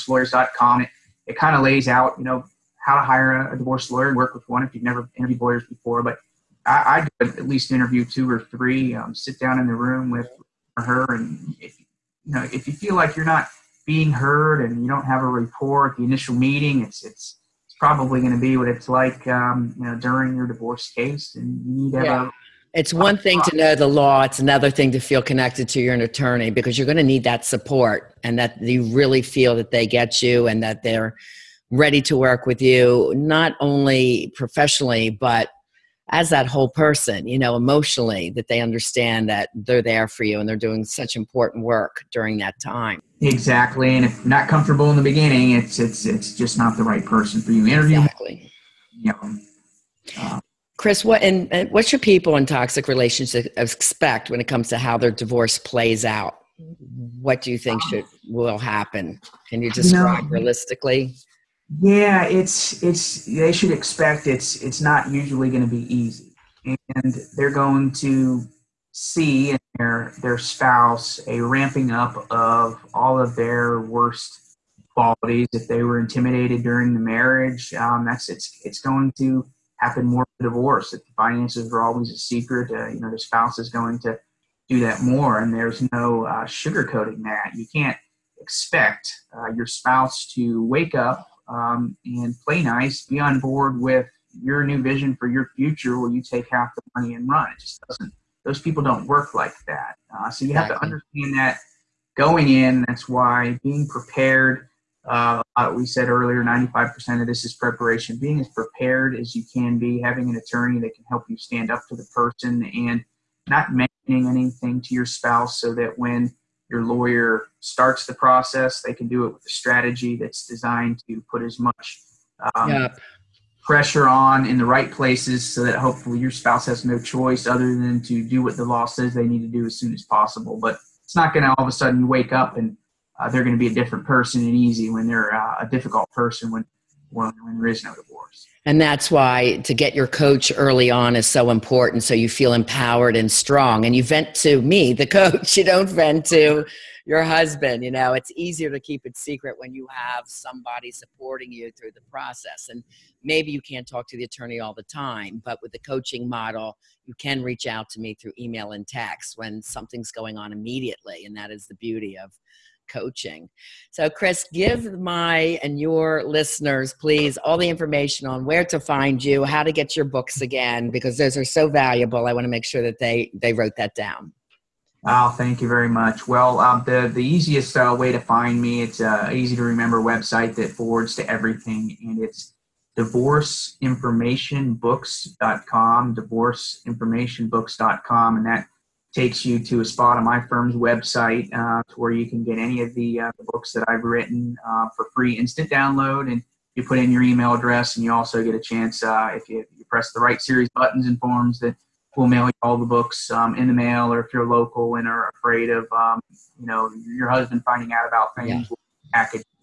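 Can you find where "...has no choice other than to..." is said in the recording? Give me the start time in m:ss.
2:06.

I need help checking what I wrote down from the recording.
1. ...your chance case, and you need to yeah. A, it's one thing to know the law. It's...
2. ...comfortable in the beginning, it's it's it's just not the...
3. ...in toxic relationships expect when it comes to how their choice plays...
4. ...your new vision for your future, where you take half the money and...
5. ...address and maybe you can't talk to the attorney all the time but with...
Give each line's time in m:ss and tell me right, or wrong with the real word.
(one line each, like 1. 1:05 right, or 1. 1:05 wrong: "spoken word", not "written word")
1. 0:20 wrong: "divorce", not "chance"
2. 0:44 right
3. 0:52 wrong: "divorce", not "choice"
4. 1:34 right
5. 2:32 wrong: "process", not "address".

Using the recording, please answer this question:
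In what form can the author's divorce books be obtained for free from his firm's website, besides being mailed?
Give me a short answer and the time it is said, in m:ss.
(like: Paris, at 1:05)
Instant download, at 3:15.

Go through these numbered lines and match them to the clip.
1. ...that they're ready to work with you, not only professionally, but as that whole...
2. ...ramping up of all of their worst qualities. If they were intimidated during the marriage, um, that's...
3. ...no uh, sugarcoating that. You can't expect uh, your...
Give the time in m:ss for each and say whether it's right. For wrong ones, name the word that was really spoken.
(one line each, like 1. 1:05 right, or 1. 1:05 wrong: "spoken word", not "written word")
1. 0:30 right
2. 1:11 right
3. 1:25 right.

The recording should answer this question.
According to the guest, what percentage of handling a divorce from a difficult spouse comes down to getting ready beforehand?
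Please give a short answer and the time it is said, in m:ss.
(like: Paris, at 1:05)
95%, at 1:46.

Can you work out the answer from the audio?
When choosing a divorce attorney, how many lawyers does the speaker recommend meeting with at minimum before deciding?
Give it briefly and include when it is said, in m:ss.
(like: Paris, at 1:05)
2 or 3, at 0:08.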